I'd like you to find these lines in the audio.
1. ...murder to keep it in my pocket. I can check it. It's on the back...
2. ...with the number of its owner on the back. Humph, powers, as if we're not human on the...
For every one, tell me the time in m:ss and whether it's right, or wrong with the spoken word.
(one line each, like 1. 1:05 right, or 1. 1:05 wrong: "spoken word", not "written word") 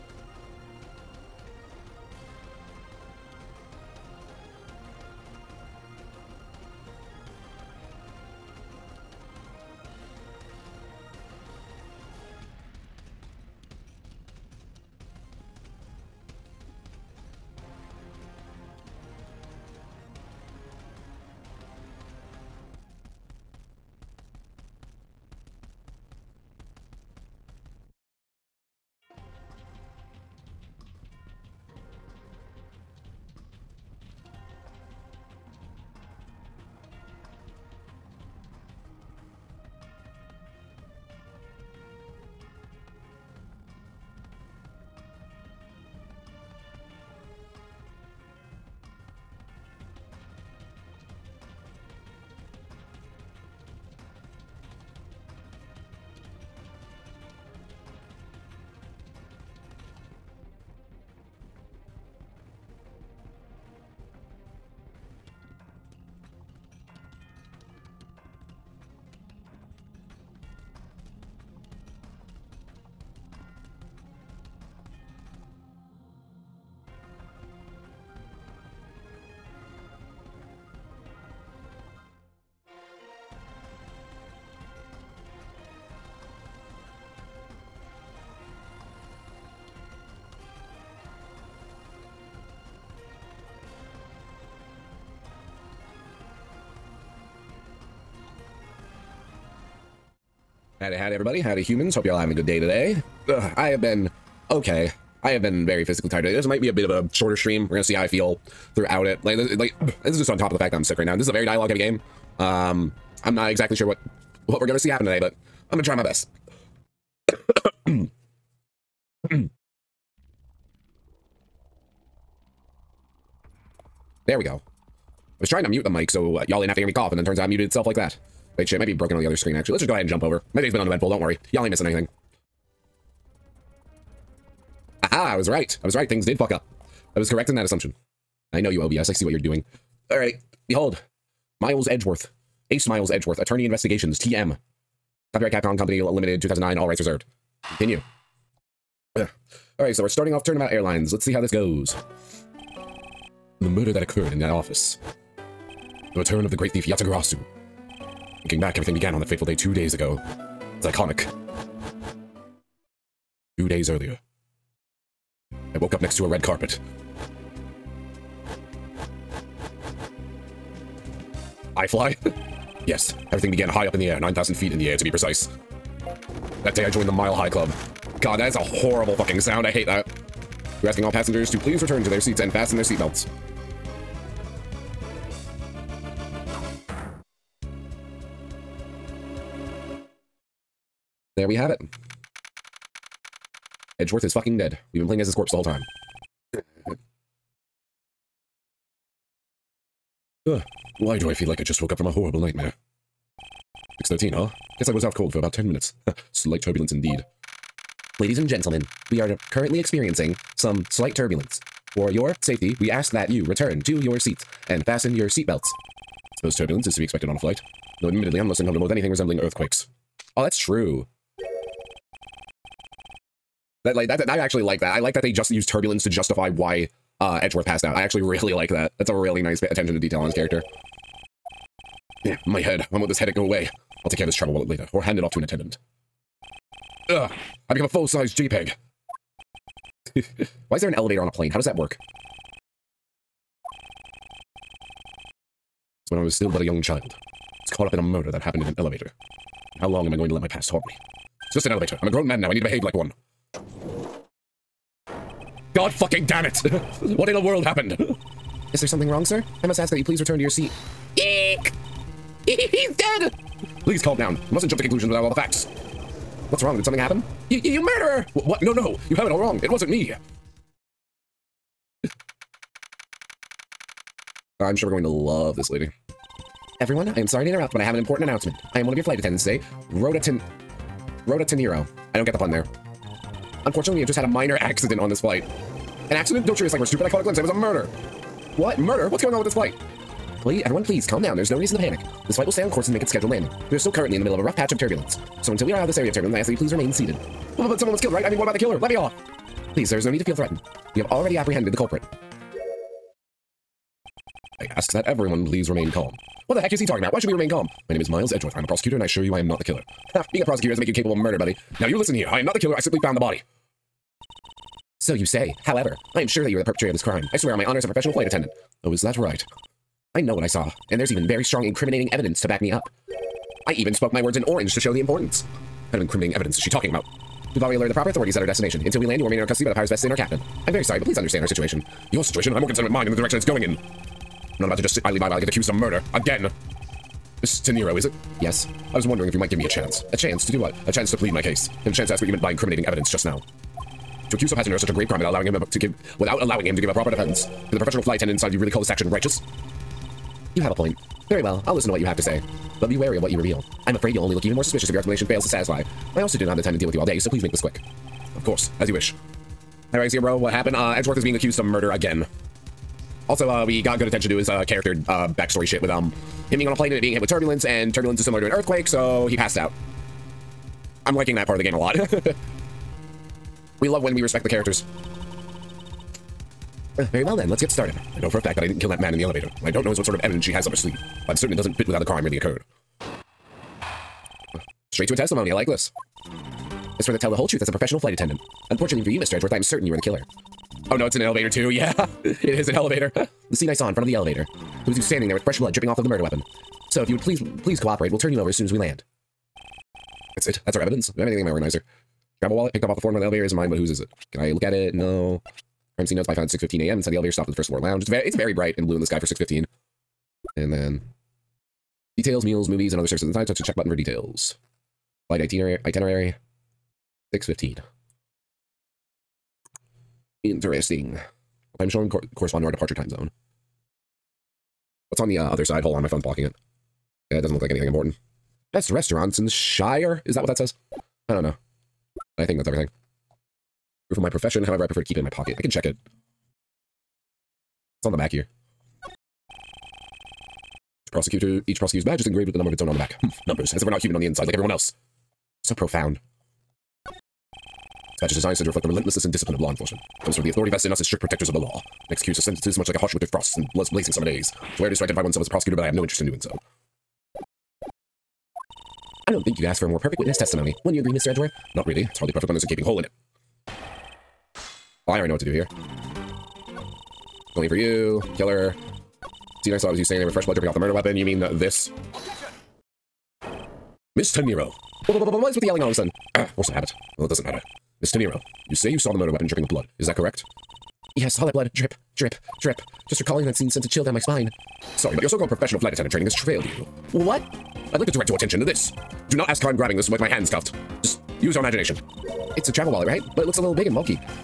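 1. 7:14 wrong: "prefer", not "murder"
2. 7:22 wrong: "numbers", not "powers".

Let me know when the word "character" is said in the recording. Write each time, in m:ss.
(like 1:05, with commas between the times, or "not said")
3:50, 6:04, 6:14.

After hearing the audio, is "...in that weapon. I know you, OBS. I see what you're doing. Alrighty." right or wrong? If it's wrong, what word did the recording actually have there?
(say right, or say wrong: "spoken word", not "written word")
wrong: "assumption", not "weapon".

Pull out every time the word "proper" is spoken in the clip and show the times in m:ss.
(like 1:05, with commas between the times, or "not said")
5:27, 5:46.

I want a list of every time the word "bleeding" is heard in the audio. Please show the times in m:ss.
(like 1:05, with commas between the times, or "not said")
not said.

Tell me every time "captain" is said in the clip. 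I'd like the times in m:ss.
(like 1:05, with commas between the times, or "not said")
5:30.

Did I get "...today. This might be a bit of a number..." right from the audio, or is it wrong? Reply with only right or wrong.
wrong.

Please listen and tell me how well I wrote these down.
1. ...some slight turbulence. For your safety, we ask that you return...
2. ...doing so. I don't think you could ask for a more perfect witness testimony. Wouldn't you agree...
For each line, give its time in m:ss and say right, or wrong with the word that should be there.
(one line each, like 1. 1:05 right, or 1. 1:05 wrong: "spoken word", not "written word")
1. 3:30 right
2. 7:36 right.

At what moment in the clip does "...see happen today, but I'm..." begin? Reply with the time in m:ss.
1:54.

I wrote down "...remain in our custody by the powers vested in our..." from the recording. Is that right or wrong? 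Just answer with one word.
right.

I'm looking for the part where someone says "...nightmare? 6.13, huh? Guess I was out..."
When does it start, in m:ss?
3:22.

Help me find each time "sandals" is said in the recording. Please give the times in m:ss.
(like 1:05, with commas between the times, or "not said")
not said.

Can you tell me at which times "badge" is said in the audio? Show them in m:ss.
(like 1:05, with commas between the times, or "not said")
7:22, 7:28.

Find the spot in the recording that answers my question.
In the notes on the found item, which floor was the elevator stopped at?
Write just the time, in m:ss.
6:47.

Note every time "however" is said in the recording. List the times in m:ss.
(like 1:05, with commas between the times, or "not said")
5:15, 7:14.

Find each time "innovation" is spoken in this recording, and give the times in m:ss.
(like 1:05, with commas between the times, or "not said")
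not said.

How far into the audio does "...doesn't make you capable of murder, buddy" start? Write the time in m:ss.
5:10.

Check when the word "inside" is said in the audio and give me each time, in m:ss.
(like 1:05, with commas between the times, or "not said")
5:48, 6:46, 6:53, 7:24.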